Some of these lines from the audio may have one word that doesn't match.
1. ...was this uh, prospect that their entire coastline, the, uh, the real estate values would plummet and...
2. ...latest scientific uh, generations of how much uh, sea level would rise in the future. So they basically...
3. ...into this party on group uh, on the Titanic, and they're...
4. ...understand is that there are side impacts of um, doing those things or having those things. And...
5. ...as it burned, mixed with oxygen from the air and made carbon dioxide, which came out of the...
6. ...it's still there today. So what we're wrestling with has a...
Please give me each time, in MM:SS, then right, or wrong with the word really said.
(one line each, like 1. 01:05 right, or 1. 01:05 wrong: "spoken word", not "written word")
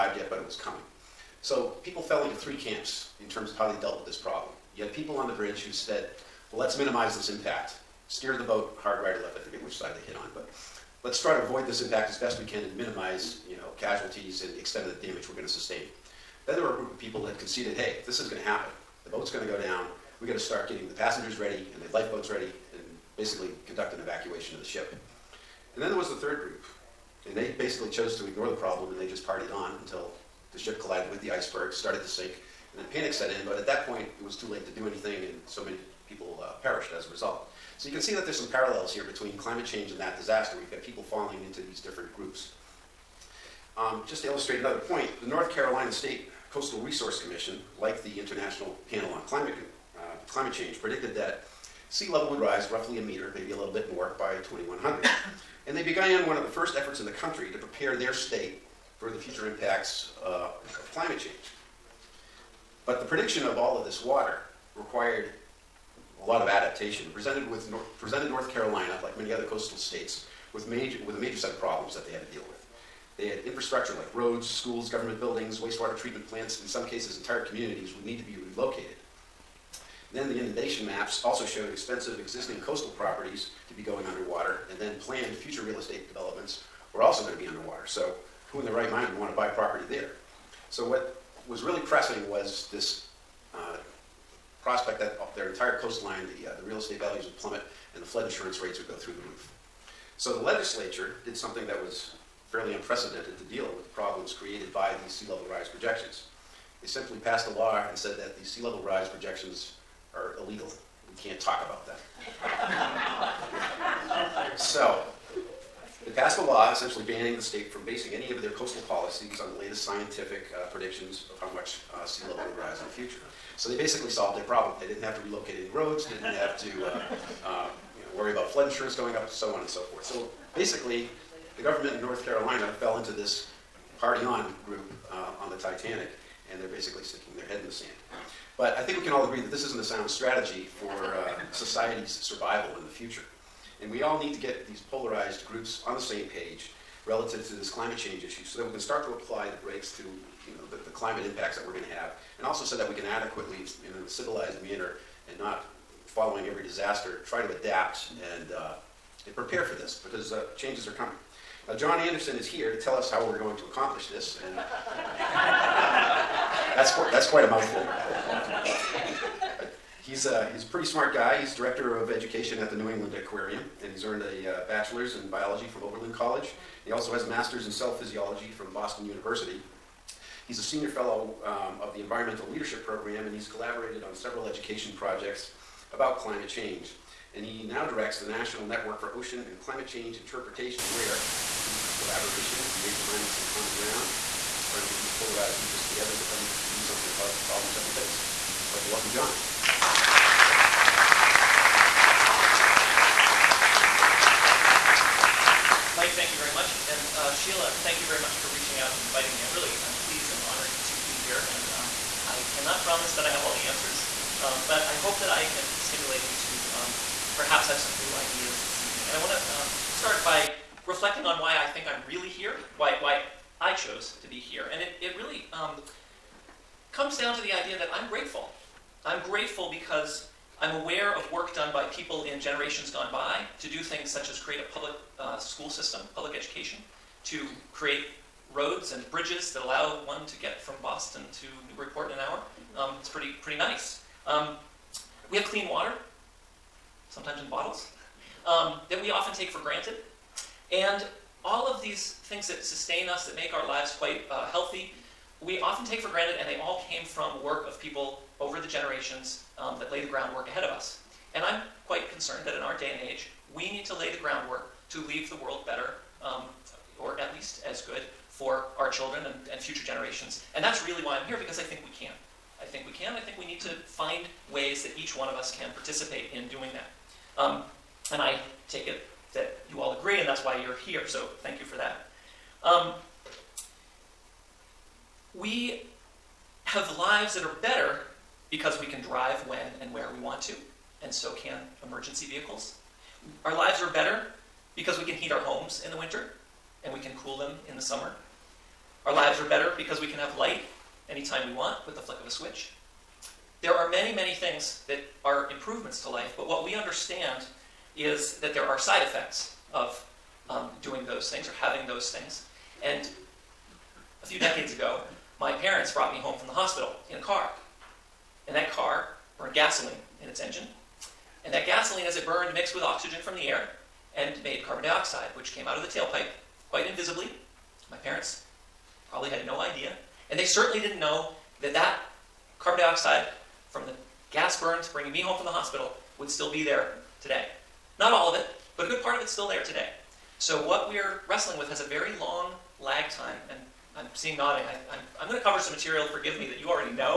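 1. 01:32 right
2. 01:59 wrong: "predictions", not "generations"
3. 02:12 right
4. 05:06 wrong: "effects", not "impacts"
5. 05:22 right
6. 05:39 right.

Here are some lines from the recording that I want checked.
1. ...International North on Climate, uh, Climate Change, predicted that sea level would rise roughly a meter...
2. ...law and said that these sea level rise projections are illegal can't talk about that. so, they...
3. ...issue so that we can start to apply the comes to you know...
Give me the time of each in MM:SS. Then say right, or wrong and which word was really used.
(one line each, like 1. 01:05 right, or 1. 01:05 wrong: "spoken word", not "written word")
1. 00:48 wrong: "Panel", not "North"
2. 01:47 right
3. 02:28 wrong: "brakes", not "comes".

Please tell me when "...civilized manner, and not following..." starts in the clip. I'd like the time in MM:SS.
02:34.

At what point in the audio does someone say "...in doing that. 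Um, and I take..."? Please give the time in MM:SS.
04:36.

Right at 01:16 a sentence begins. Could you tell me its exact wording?
In some cases, entire communities would need to be relocated.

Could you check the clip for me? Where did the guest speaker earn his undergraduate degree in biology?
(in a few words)
Oberlin College.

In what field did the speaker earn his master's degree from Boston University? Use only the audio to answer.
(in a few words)
cell physiology.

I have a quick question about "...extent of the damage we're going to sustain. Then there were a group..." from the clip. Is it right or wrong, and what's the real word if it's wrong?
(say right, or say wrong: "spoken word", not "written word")
right.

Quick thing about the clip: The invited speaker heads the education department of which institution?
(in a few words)
New England Aquarium.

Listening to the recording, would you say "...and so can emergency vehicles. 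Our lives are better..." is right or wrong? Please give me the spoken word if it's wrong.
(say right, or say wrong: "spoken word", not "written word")
right.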